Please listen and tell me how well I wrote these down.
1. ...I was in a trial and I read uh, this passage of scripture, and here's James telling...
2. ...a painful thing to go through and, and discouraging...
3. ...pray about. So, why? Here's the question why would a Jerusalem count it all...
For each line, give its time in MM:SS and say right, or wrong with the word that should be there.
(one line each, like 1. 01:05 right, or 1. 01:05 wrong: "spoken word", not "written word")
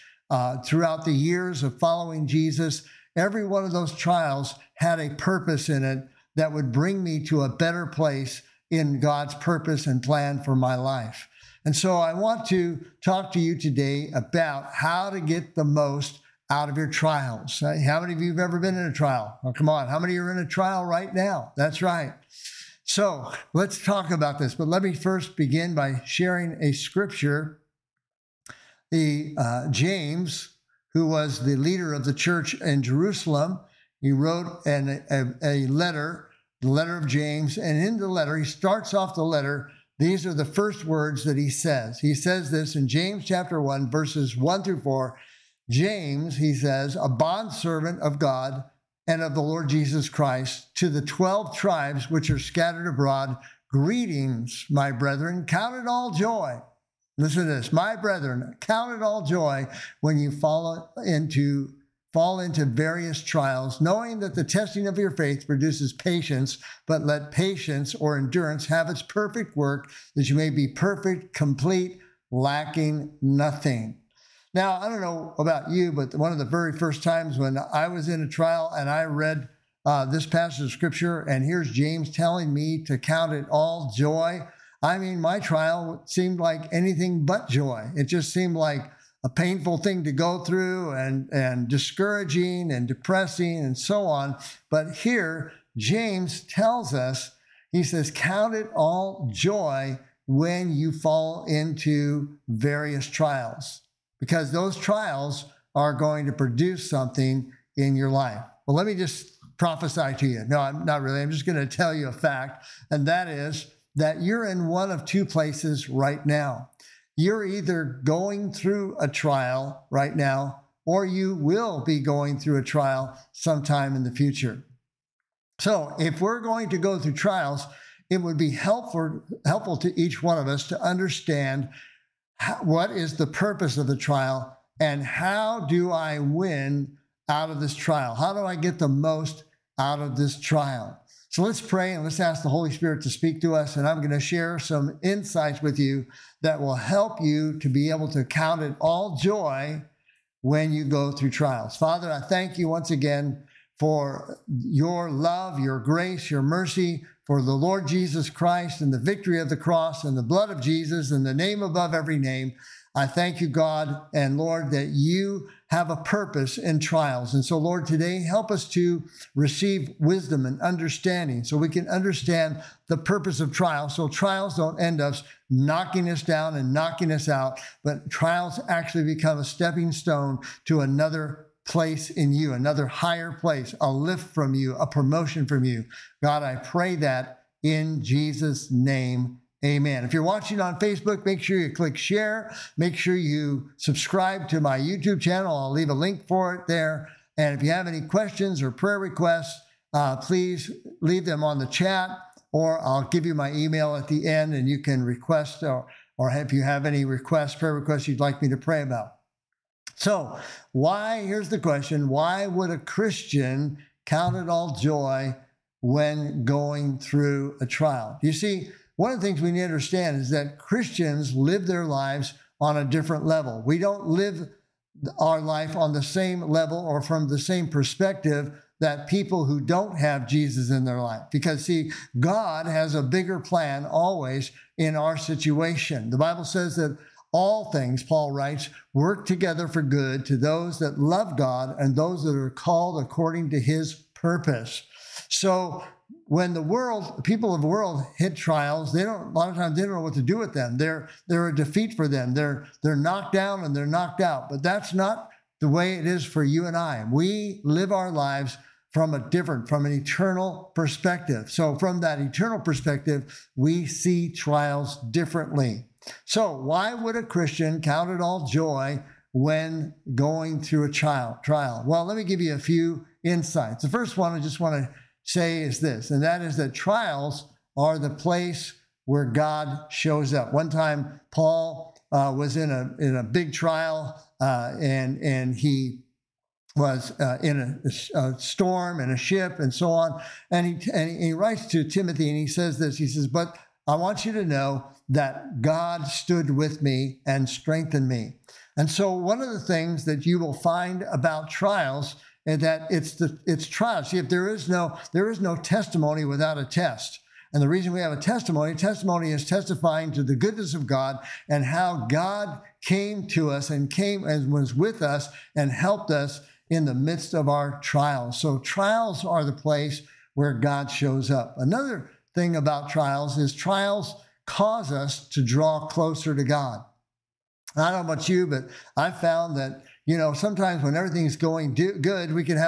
1. 01:17 right
2. 01:29 right
3. 03:28 wrong: "Christian", not "Jerusalem".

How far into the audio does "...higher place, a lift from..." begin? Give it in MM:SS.
03:02.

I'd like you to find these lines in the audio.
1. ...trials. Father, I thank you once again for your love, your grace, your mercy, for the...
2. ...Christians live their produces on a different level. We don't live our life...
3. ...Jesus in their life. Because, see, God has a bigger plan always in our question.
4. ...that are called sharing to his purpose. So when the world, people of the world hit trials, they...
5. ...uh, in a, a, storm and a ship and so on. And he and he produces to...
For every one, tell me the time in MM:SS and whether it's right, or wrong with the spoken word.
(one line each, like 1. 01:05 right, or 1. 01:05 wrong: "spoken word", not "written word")
1. 02:31 right
2. 03:40 wrong: "lives", not "produces"
3. 03:50 wrong: "situation", not "question"
4. 04:02 wrong: "according", not "sharing"
5. 04:47 wrong: "writes", not "produces".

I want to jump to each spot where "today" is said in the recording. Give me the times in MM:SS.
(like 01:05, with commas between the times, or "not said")
00:13, 02:47.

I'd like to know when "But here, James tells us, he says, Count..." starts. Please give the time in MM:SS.
01:34.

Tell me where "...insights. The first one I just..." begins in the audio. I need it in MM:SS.
04:33.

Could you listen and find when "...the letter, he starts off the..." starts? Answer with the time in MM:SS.
00:37.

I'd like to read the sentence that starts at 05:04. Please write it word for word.
See, if there is no there is no testimony without a test.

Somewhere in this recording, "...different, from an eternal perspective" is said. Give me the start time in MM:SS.
04:19.